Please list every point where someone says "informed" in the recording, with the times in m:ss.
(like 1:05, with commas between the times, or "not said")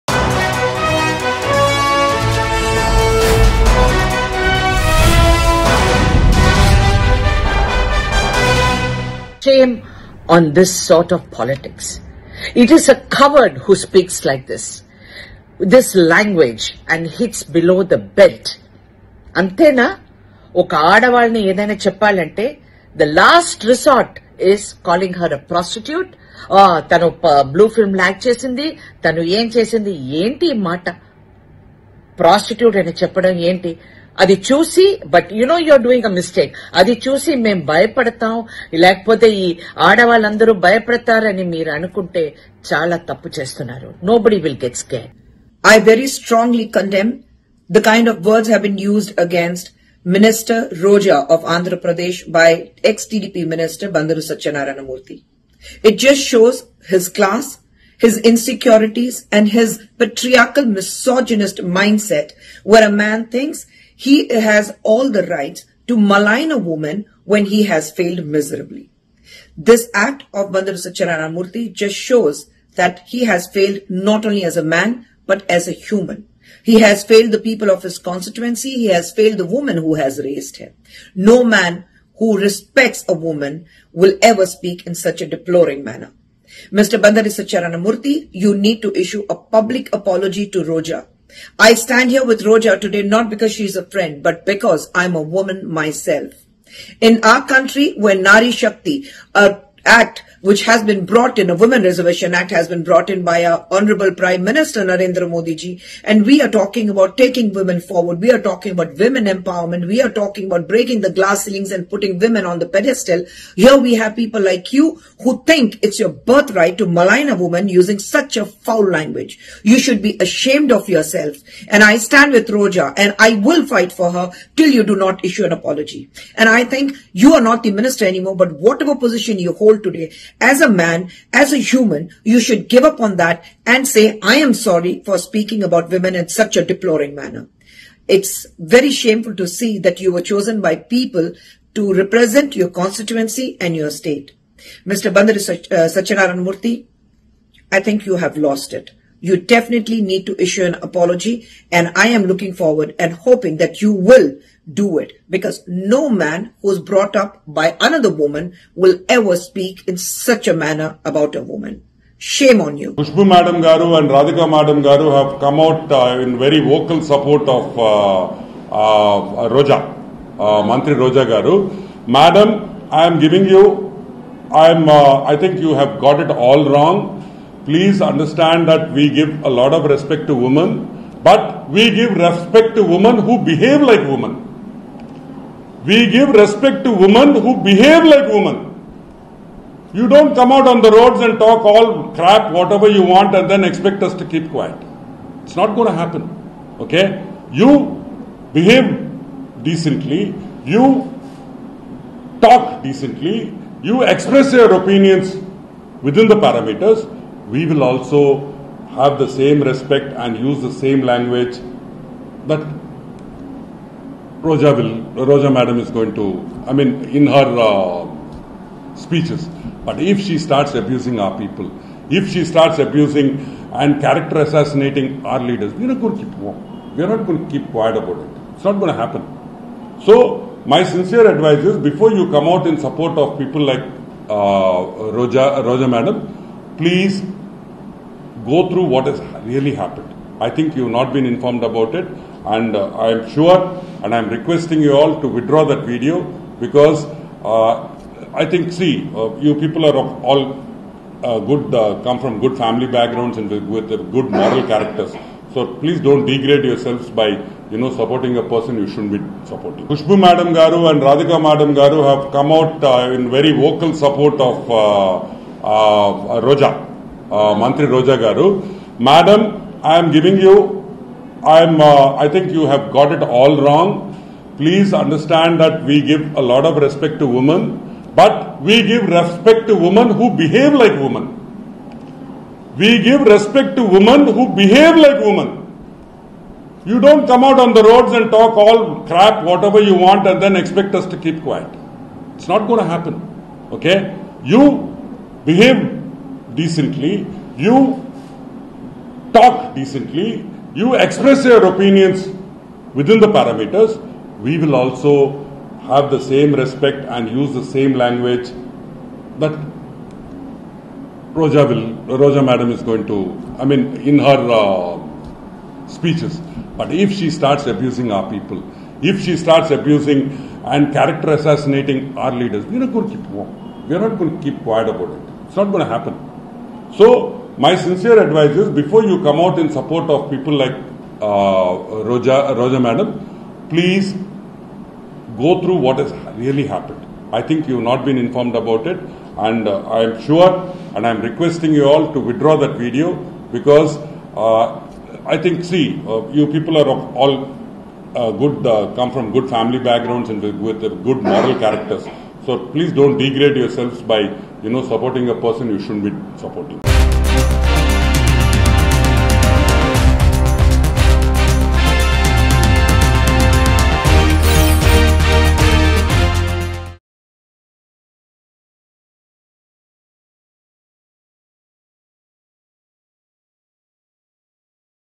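4:01, 5:38.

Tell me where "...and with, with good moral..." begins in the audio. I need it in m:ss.
5:50.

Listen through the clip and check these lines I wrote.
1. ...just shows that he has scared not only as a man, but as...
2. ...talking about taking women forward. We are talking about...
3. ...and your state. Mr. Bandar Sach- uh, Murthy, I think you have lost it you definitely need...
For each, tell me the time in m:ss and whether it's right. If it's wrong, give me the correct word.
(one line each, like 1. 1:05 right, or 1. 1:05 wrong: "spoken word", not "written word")
1. 1:11 wrong: "failed", not "scared"
2. 1:46 right
3. 2:23 right.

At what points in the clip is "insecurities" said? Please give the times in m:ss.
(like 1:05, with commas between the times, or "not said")
0:58.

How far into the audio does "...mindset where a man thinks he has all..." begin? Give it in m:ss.
1:01.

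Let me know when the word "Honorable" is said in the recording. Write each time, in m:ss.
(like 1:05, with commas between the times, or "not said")
1:43.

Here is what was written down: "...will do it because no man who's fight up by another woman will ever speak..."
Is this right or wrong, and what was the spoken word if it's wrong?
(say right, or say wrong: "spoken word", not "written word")
wrong: "brought", not "fight".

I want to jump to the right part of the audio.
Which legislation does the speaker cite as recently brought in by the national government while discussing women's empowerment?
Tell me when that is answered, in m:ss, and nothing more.
1:41.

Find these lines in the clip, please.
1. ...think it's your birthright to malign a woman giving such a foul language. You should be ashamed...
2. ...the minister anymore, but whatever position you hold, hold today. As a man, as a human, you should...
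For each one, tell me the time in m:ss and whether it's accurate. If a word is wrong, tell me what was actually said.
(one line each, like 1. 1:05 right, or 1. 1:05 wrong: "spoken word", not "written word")
1. 1:55 wrong: "using", not "giving"
2. 2:07 right.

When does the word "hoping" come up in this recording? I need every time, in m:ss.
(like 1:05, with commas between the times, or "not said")
2:33.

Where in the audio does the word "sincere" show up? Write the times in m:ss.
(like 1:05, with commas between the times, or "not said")
3:50, 5:27.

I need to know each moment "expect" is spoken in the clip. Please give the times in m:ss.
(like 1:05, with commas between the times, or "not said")
3:13, 4:50.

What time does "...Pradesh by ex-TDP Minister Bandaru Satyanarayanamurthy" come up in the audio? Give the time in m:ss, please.
0:51.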